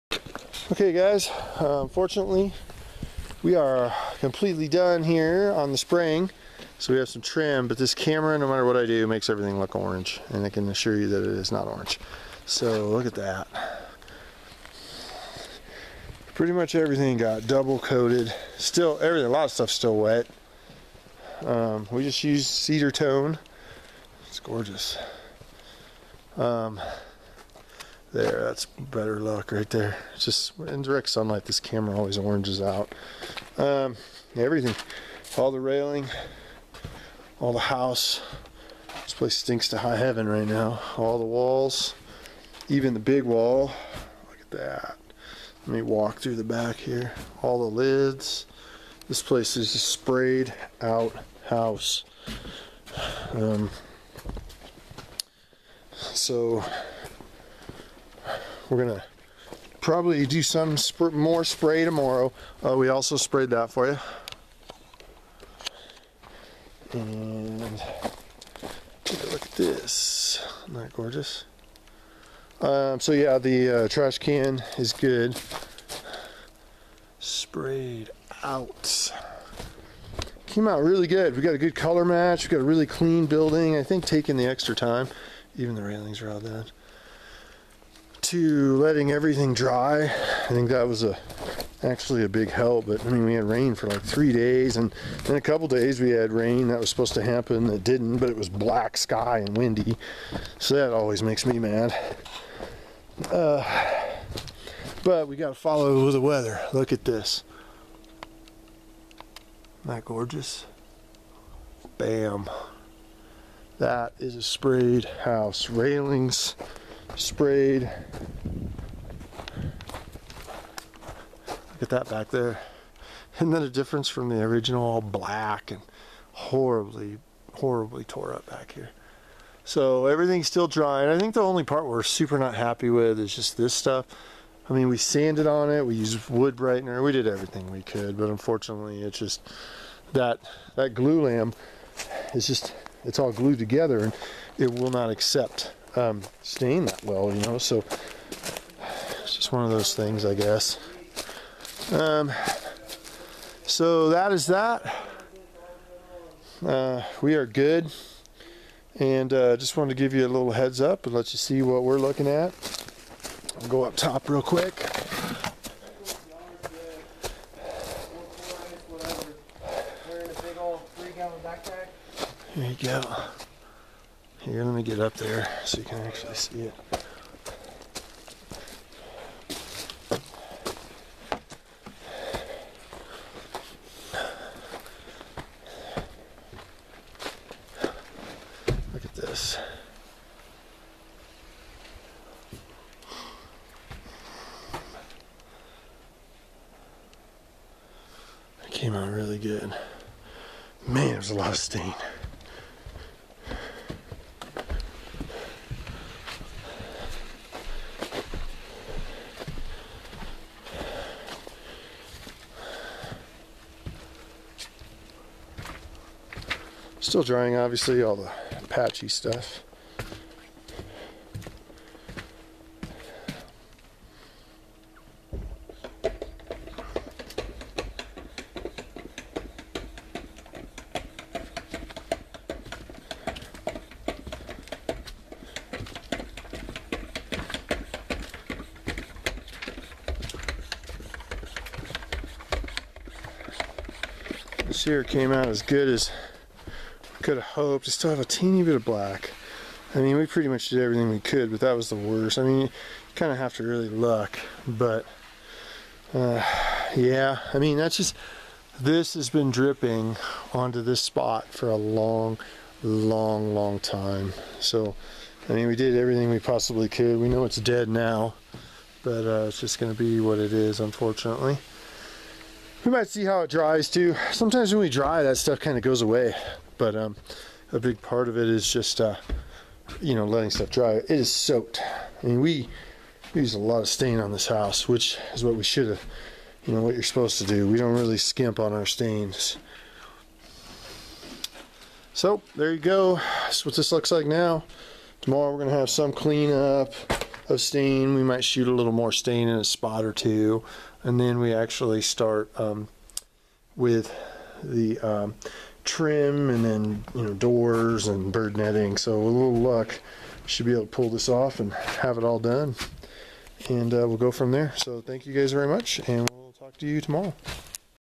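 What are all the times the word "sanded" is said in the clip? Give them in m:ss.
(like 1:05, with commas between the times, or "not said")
2:14.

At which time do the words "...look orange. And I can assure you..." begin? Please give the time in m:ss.
0:09.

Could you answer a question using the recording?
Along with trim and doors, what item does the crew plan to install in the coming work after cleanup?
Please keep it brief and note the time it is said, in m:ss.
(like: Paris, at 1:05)
Bird netting, at 5:08.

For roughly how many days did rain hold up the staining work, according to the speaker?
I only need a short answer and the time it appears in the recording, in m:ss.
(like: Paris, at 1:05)
3, at 1:34.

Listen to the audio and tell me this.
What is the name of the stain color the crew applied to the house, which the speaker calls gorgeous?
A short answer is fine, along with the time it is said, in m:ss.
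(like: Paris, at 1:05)
Cedar tone, at 0:22.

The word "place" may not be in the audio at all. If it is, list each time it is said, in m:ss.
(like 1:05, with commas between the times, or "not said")
0:39, 0:49.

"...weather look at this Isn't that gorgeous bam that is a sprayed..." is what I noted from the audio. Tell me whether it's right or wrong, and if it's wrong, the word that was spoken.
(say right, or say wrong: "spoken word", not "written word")
right.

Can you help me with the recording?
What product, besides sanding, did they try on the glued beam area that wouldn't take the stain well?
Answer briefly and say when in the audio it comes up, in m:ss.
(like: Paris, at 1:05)
Wood brightener, at 2:16.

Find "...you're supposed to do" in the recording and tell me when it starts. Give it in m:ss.
4:46.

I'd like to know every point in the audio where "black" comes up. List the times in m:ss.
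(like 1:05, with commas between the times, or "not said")
1:38, 2:05, 4:08.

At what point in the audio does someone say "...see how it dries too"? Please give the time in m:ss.
4:33.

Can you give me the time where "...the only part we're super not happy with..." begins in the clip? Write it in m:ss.
2:11.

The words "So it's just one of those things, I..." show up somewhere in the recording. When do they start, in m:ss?
2:27.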